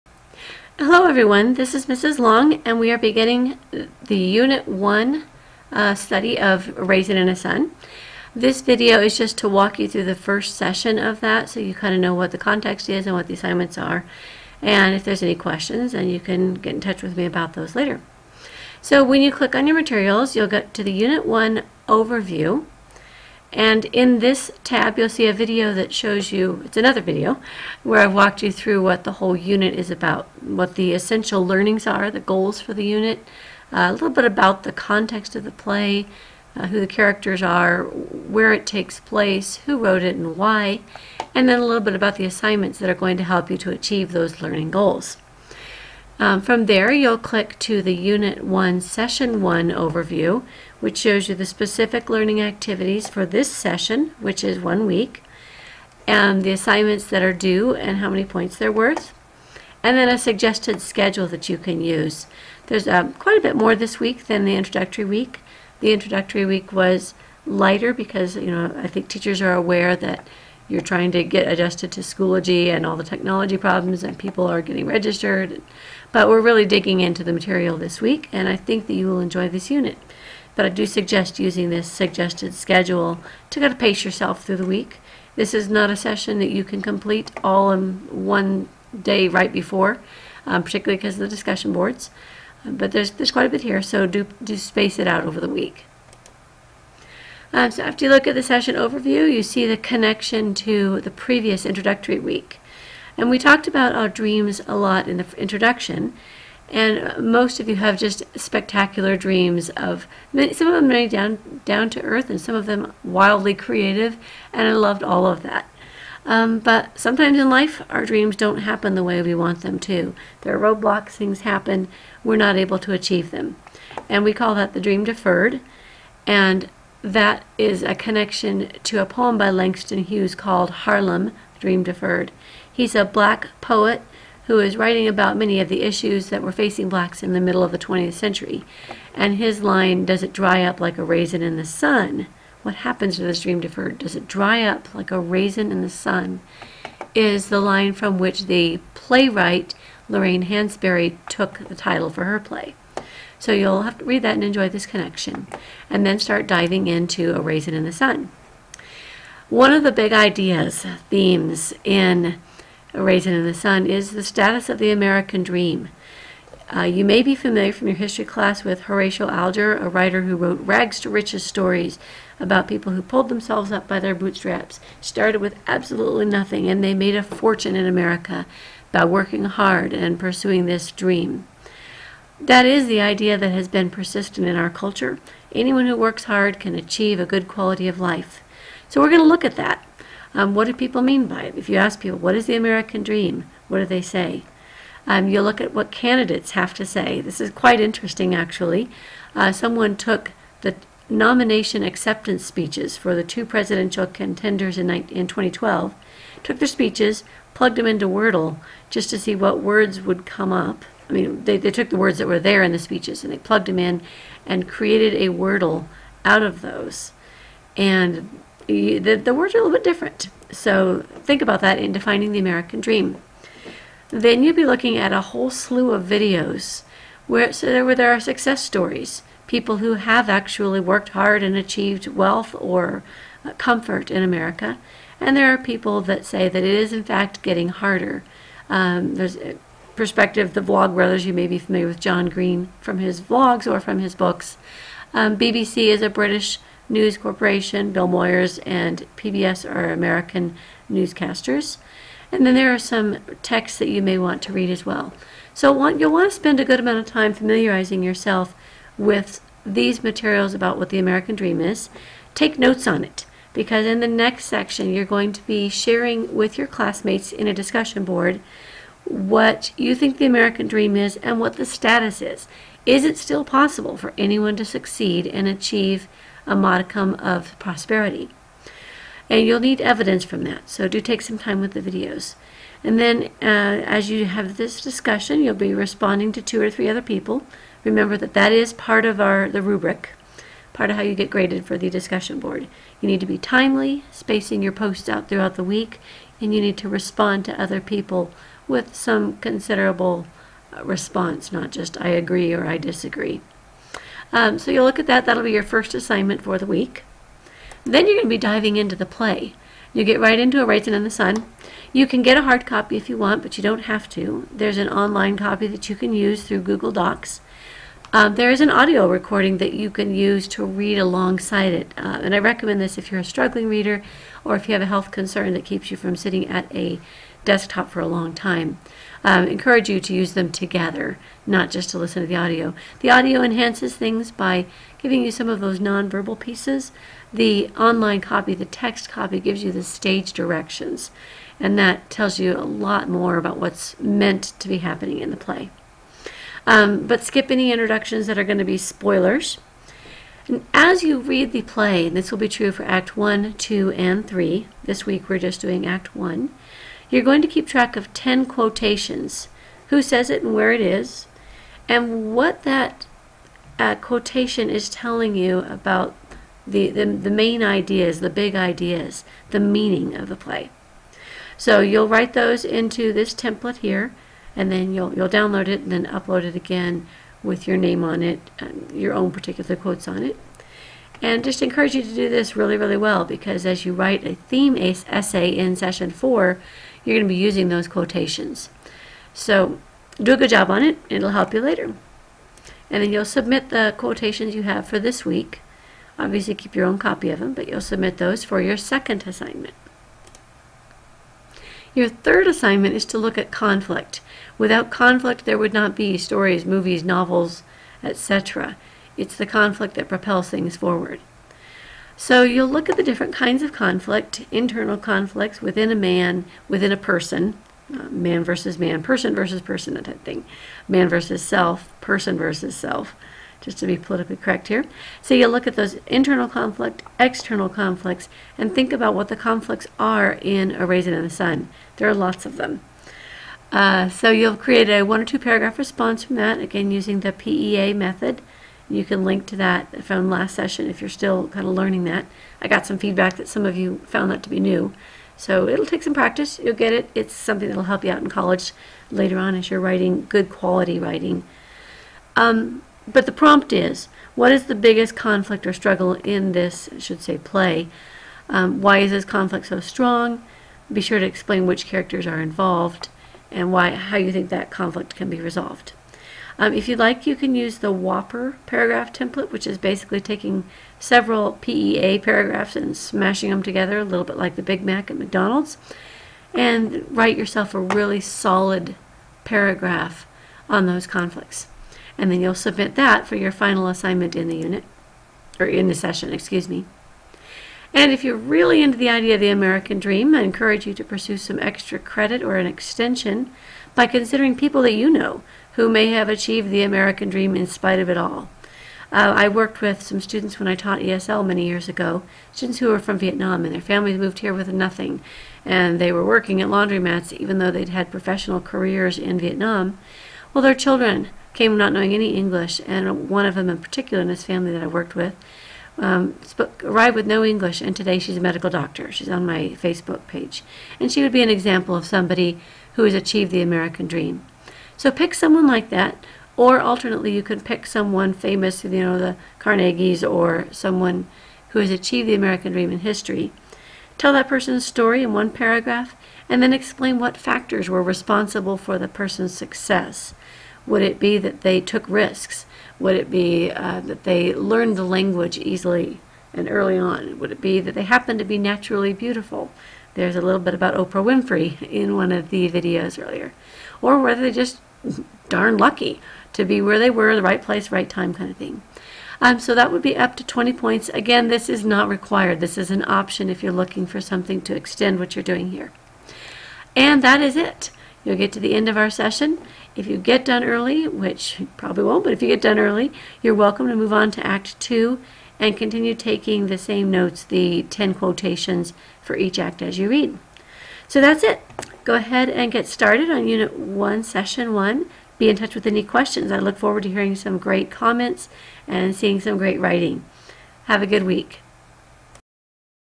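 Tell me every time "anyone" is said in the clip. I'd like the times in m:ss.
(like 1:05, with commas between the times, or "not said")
3:05, 4:34.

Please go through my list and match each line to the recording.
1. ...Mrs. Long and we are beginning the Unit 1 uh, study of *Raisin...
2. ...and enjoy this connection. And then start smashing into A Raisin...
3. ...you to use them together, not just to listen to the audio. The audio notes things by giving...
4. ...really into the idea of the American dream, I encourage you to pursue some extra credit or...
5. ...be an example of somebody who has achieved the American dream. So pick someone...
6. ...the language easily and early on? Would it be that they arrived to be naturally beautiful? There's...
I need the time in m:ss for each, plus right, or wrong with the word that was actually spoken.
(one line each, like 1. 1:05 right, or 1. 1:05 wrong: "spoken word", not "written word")
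1. 0:01 right
2. 2:34 wrong: "diving", not "smashing"
3. 5:29 wrong: "enhances", not "notes"
4. 8:08 right
5. 8:41 right
6. 9:04 wrong: "happened", not "arrived".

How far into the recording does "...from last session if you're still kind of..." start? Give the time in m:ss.
7:20.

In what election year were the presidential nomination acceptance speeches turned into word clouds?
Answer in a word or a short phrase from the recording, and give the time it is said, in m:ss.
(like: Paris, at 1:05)
2012, at 3:25.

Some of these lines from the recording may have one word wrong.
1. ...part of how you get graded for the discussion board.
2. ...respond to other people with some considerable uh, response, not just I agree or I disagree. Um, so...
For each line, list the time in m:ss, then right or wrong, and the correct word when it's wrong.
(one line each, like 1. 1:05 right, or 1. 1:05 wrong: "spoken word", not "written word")
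1. 4:50 right
2. 4:56 right.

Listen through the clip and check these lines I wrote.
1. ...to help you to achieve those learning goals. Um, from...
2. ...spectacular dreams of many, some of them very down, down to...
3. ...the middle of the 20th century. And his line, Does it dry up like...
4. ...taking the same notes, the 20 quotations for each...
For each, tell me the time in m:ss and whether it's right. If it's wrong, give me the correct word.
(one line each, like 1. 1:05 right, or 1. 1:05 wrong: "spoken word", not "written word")
1. 0:43 right
2. 1:48 right
3. 2:17 right
4. 9:36 wrong: "10", not "20".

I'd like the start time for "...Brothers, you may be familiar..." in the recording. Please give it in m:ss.
4:00.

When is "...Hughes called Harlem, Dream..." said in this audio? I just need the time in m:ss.
2:10.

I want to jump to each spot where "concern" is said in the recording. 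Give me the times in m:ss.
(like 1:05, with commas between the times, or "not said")
5:25.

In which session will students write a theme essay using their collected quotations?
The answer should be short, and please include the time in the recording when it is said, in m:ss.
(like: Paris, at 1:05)
session four, at 6:25.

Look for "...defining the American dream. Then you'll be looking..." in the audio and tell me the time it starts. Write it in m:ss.
3:41.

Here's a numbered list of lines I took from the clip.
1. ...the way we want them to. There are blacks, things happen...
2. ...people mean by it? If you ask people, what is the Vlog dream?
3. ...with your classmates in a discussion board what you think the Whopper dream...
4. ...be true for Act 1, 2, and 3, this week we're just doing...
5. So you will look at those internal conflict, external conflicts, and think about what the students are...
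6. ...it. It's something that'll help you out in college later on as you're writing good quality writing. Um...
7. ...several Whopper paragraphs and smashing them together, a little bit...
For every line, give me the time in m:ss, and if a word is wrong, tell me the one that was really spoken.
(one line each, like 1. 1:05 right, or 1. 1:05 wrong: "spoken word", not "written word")
1. 1:58 wrong: "roadblocks", not "blacks"
2. 3:10 wrong: "American", not "Vlog"
3. 4:26 wrong: "American", not "Whopper"
4. 5:52 right
5. 7:05 wrong: "conflicts", not "students"
6. 7:26 right
7. 7:50 wrong: "PEA", not "Whopper".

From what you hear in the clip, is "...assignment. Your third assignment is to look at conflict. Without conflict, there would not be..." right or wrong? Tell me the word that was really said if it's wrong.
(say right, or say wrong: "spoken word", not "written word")
right.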